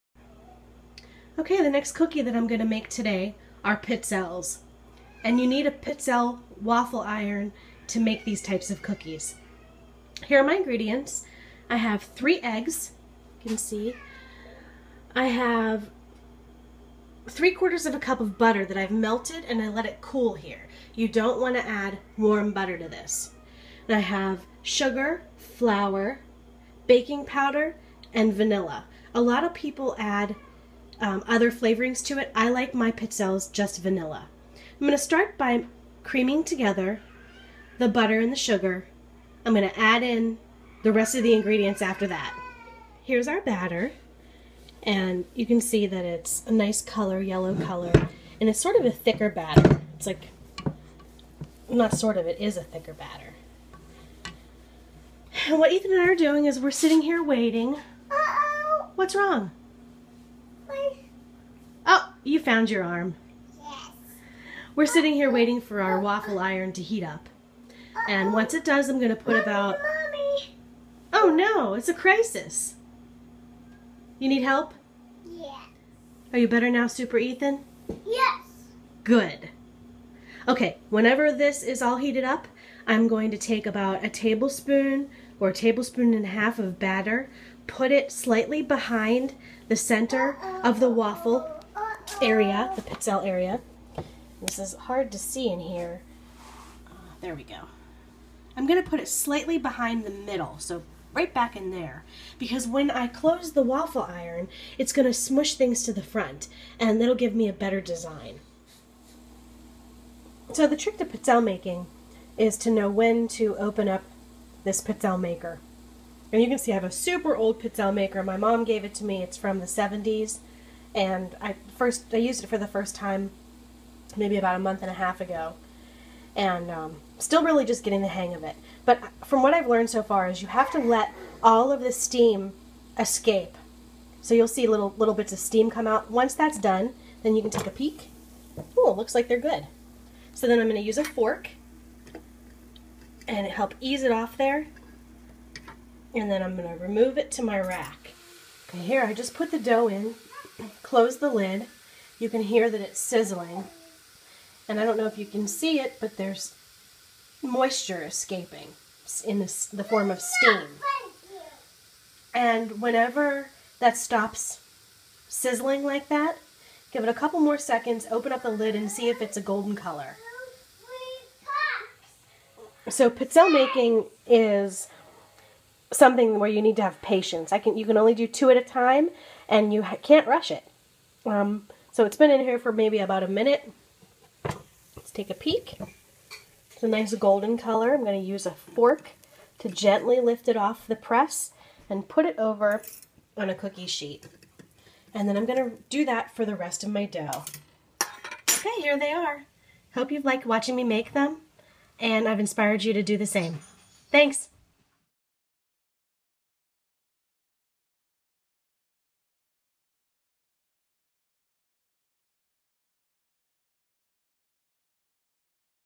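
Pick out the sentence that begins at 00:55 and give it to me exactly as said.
And what Ethan and I are doing is we're sitting here waiting.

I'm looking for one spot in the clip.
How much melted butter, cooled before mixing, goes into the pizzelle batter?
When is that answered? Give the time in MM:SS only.
00:17.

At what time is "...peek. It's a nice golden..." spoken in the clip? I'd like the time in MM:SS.
03:05.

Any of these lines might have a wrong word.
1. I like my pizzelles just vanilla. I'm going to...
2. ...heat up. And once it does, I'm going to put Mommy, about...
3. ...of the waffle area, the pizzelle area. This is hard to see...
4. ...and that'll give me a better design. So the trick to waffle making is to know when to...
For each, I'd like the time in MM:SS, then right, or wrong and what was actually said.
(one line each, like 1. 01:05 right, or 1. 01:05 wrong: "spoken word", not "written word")
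1. 00:32 right
2. 01:06 right
3. 01:30 right
4. 01:46 wrong: "pizzelle", not "waffle".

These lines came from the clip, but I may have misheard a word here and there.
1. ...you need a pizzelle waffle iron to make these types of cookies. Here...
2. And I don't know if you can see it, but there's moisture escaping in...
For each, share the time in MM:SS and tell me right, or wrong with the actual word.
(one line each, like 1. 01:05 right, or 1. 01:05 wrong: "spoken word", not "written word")
1. 00:05 right
2. 02:34 right.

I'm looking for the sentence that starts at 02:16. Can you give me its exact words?
Once that's done, then you can take a peek.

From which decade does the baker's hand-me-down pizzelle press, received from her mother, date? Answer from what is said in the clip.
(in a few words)
the 70s.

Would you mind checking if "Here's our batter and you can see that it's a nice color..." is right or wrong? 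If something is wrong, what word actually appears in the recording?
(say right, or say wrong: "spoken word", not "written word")
right.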